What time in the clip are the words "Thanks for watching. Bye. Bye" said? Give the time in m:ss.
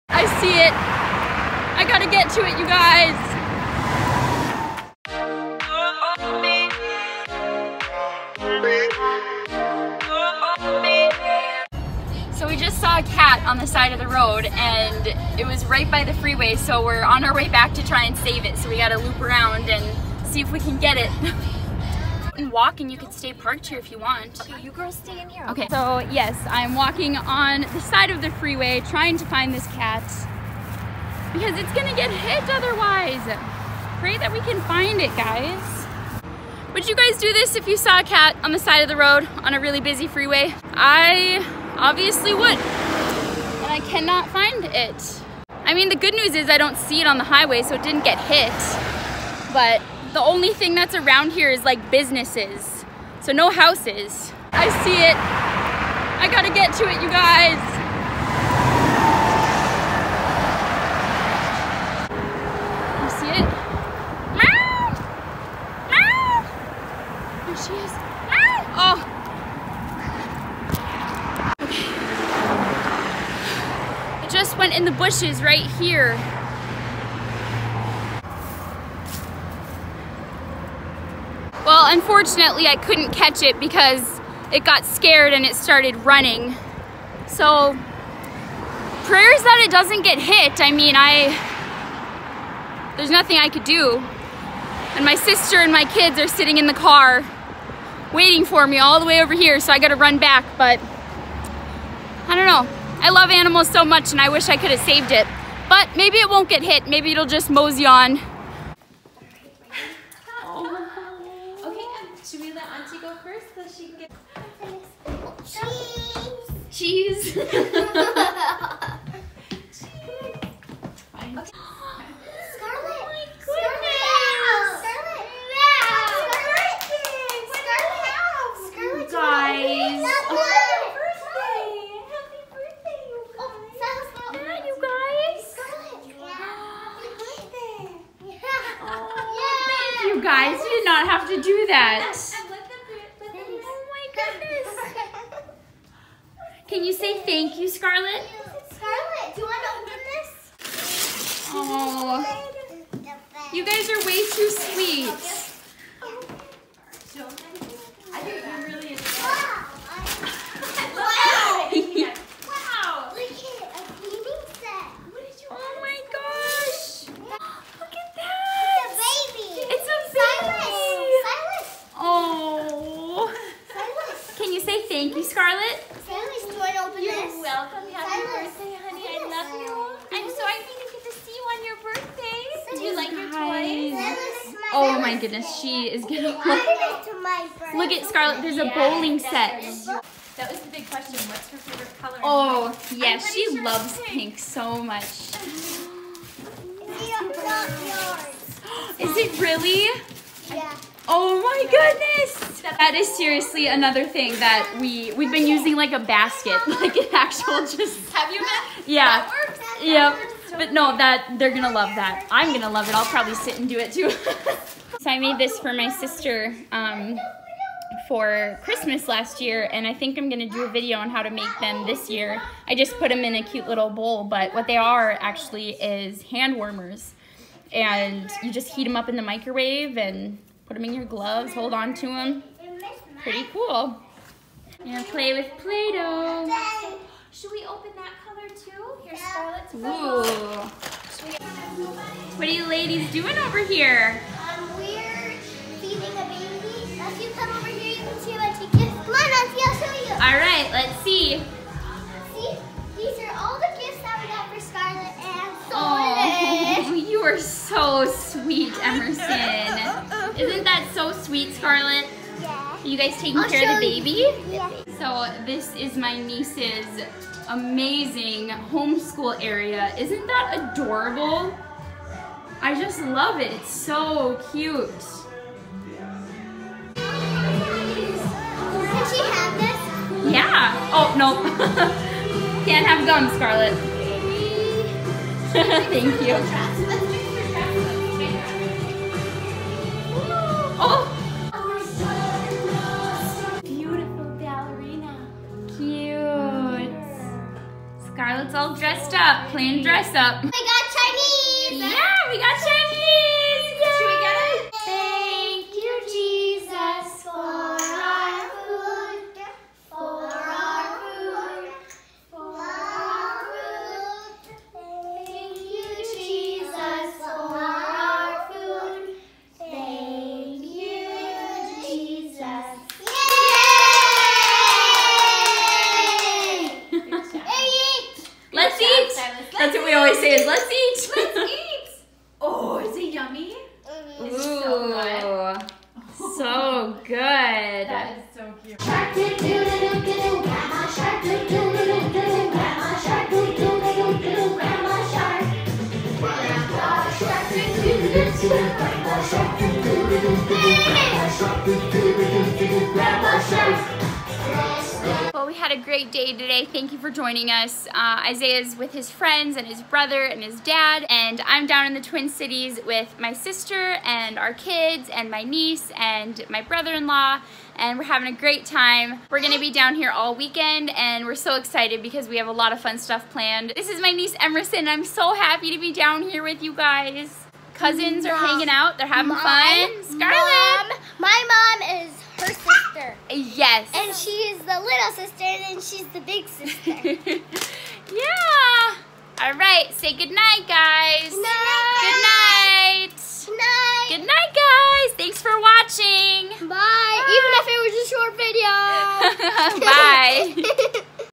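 6:35.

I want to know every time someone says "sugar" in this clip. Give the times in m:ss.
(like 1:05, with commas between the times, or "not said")
not said.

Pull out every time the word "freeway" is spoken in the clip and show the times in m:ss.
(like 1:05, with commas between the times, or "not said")
0:16, 0:28, 0:40.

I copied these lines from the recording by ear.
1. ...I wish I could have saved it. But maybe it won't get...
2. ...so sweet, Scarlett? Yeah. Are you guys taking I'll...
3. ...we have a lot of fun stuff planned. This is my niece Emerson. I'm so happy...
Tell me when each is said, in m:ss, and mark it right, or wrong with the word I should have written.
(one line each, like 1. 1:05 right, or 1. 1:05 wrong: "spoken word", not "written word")
1. 1:44 right
2. 4:20 right
3. 6:12 right.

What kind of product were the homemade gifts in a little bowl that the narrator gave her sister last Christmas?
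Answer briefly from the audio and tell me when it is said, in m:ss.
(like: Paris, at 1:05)
Hand warmers, at 3:46.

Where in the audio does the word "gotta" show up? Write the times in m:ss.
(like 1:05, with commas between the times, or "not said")
0:01, 0:18, 0:56, 1:39.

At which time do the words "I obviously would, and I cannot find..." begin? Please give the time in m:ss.
0:40.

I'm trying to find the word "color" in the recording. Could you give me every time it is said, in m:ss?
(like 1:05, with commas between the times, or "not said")
3:11, 3:58.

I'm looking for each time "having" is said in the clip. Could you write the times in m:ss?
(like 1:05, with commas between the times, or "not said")
6:08, 6:19.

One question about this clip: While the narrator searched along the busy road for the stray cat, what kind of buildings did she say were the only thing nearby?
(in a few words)
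Businesses.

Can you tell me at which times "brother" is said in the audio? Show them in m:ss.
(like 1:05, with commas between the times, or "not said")
5:59, 6:06.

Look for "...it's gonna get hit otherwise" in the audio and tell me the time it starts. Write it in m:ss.
0:31.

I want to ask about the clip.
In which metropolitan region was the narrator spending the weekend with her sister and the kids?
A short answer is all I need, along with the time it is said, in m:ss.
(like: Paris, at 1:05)
Twin Cities, at 6:02.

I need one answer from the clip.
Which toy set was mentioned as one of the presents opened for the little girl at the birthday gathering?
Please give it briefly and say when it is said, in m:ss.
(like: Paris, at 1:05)
Bowling set, at 3:08.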